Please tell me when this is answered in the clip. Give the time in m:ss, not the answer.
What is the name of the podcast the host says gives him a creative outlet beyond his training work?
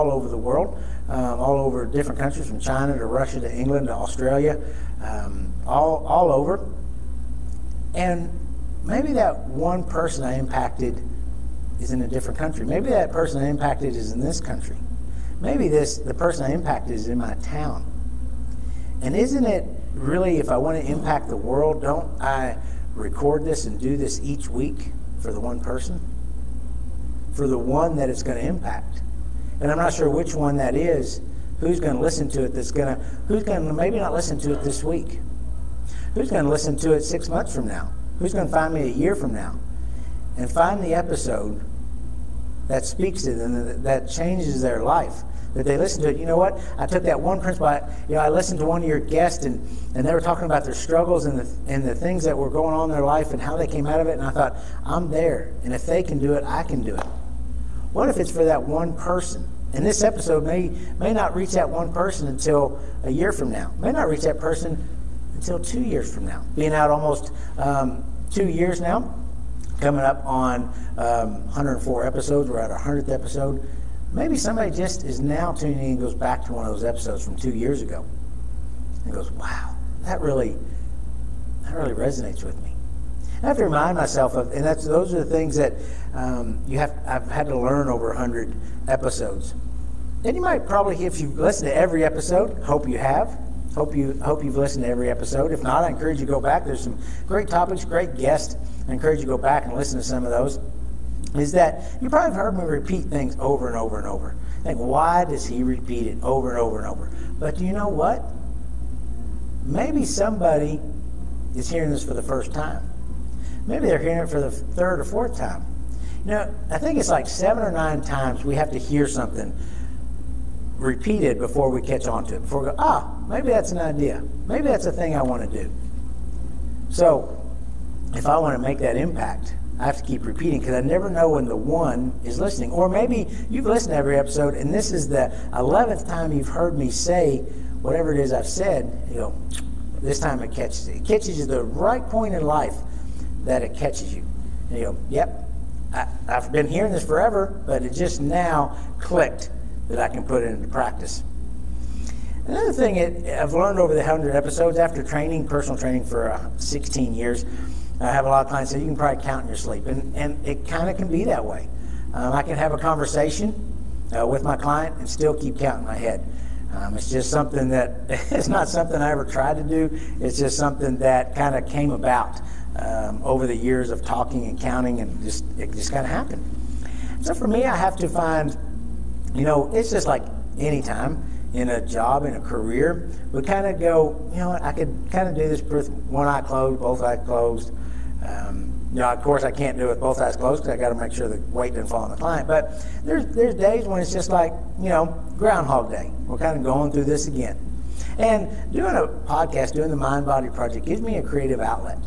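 3:19.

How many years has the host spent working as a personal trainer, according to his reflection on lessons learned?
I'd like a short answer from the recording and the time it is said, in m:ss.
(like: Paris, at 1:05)
16, at 2:36.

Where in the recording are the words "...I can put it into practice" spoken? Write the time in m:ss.
2:29.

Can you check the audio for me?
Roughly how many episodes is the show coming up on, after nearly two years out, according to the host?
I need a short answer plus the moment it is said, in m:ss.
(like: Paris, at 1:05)
104, at 1:11.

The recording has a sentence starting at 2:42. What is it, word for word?
Um, I can have a conversation uh, with my client and still keep counting my head.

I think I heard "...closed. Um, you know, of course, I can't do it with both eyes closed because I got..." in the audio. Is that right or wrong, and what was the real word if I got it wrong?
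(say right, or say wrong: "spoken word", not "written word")
right.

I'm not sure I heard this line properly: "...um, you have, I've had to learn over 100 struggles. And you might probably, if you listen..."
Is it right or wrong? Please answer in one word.
wrong.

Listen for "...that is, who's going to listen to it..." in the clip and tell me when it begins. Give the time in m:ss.
0:30.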